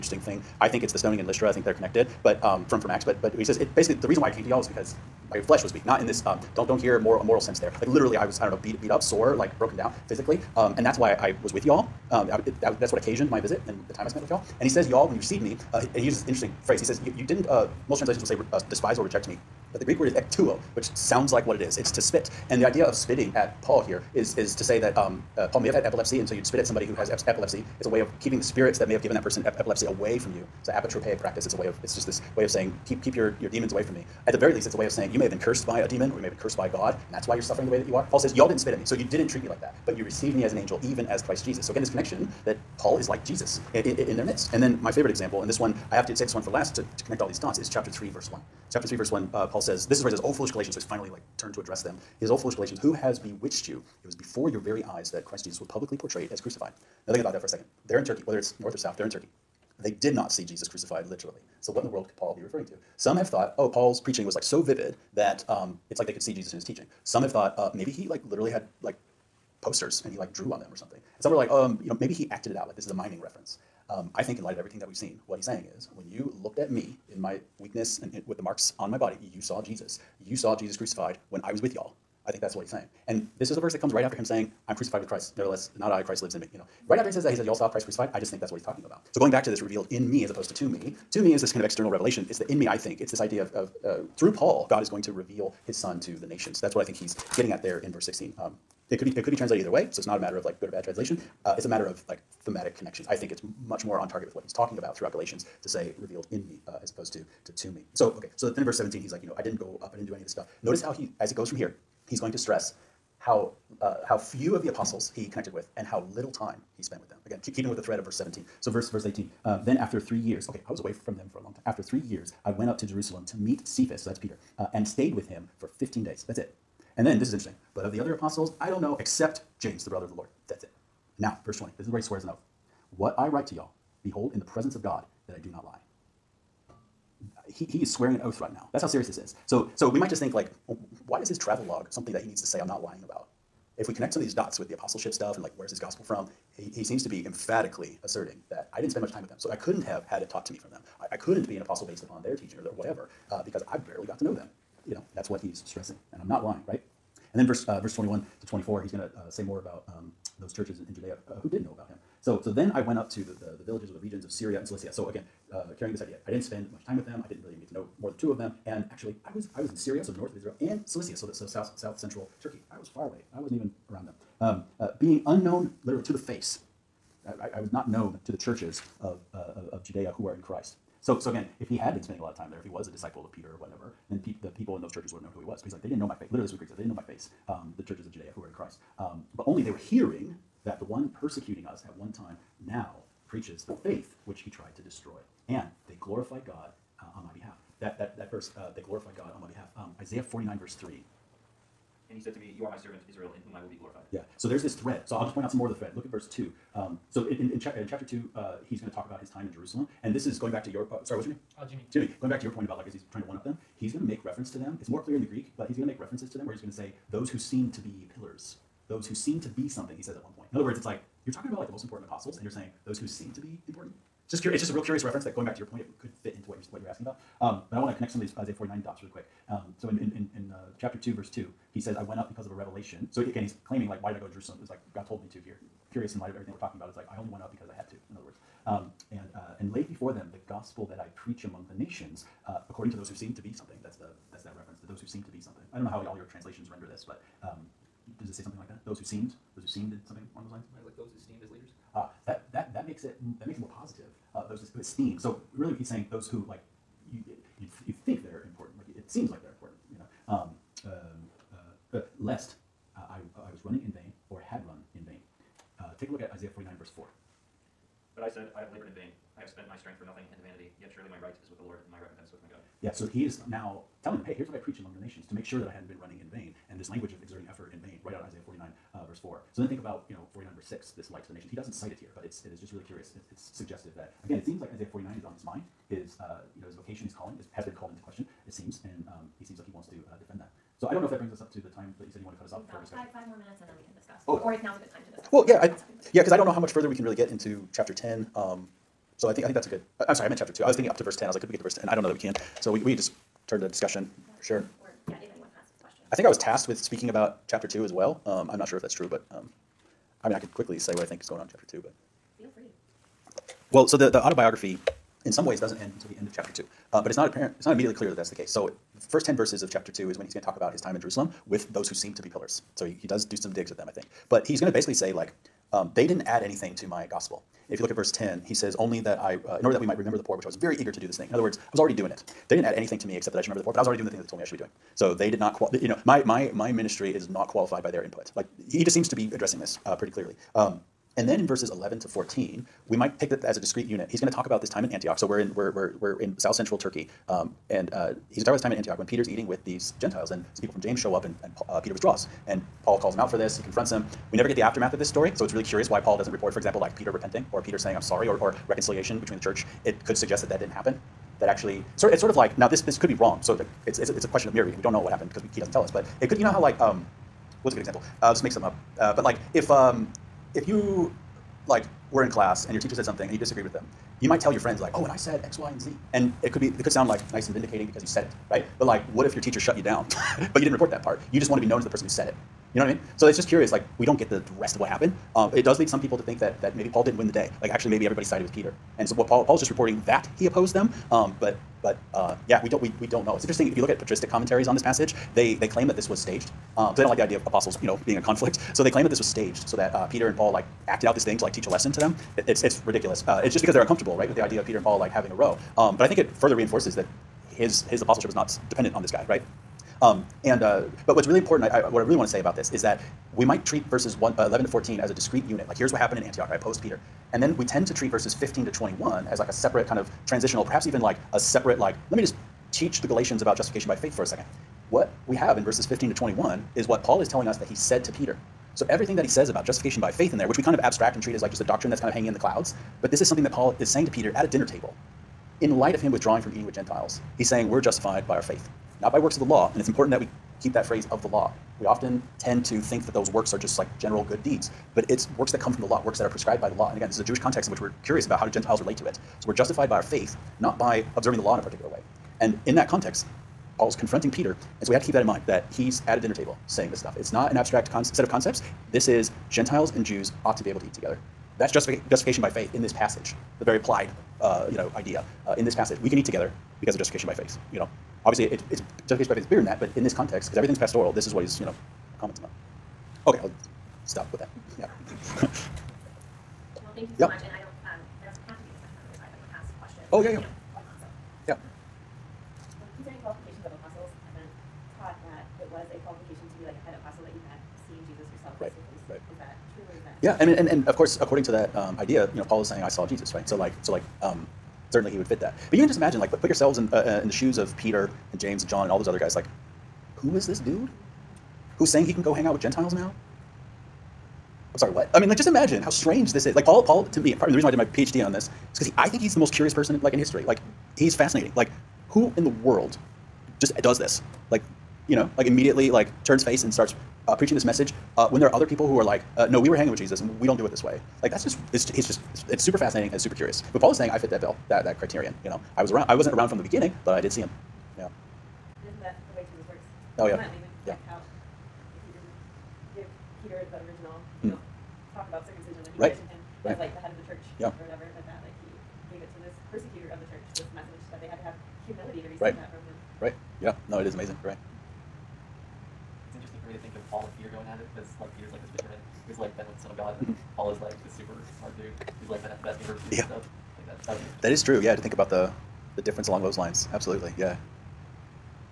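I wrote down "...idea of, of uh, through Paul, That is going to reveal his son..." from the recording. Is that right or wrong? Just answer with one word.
wrong.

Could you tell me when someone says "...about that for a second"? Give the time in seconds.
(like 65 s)
57 s.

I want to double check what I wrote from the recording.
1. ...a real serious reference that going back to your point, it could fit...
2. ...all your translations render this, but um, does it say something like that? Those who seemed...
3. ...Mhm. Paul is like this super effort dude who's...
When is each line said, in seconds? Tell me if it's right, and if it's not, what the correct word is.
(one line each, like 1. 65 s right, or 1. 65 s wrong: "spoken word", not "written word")
1. 224 s wrong: "curious", not "serious"
2. 246 s right
3. 550 s wrong: "smart", not "effort".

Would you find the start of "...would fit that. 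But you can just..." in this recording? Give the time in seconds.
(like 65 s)
495 s.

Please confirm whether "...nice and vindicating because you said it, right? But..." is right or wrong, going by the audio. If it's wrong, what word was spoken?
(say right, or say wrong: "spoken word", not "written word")
right.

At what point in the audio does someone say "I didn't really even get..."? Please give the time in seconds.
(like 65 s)
167 s.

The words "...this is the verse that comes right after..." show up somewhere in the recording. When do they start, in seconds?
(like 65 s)
83 s.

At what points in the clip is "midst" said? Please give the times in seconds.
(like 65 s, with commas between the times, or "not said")
44 s.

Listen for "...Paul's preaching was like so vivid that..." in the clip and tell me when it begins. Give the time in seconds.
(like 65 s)
63 s.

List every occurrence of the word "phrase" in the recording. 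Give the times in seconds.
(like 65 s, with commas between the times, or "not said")
16 s, 440 s.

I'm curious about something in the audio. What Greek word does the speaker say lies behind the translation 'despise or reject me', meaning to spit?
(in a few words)
ekptuo.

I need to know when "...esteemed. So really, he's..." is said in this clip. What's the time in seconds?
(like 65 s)
254 s.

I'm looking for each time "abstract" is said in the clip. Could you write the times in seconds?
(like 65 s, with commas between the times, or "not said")
430 s, 457 s.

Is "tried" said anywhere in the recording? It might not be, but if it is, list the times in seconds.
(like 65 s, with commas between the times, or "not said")
194 s.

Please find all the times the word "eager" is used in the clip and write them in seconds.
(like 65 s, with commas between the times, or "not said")
330 s.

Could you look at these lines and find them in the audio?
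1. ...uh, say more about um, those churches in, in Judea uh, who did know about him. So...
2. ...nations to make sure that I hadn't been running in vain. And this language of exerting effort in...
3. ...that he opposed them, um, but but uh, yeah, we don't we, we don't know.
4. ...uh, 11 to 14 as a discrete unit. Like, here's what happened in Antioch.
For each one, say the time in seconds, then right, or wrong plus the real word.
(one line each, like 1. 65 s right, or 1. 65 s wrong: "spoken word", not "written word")
1. 159 s right
2. 275 s right
3. 390 s right
4. 414 s right.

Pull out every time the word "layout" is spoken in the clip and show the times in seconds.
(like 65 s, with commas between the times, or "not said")
not said.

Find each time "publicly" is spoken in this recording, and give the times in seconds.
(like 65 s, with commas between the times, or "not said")
55 s.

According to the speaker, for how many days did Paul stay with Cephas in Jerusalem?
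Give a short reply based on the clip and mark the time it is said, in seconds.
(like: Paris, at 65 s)
15, at 125 s.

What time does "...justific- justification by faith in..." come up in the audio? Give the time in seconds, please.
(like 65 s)
461 s.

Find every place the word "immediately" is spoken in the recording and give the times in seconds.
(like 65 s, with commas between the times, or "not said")
317 s, 515 s.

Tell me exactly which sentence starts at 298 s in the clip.
Um, so I think, I think that's a good, I'm sorry, I meant chapter two.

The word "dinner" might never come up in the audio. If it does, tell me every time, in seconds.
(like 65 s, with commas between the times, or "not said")
434 s, 456 s.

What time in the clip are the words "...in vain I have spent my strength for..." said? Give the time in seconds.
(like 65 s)
268 s.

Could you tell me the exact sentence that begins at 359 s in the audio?
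It could suggest that that didn't happen, that actually.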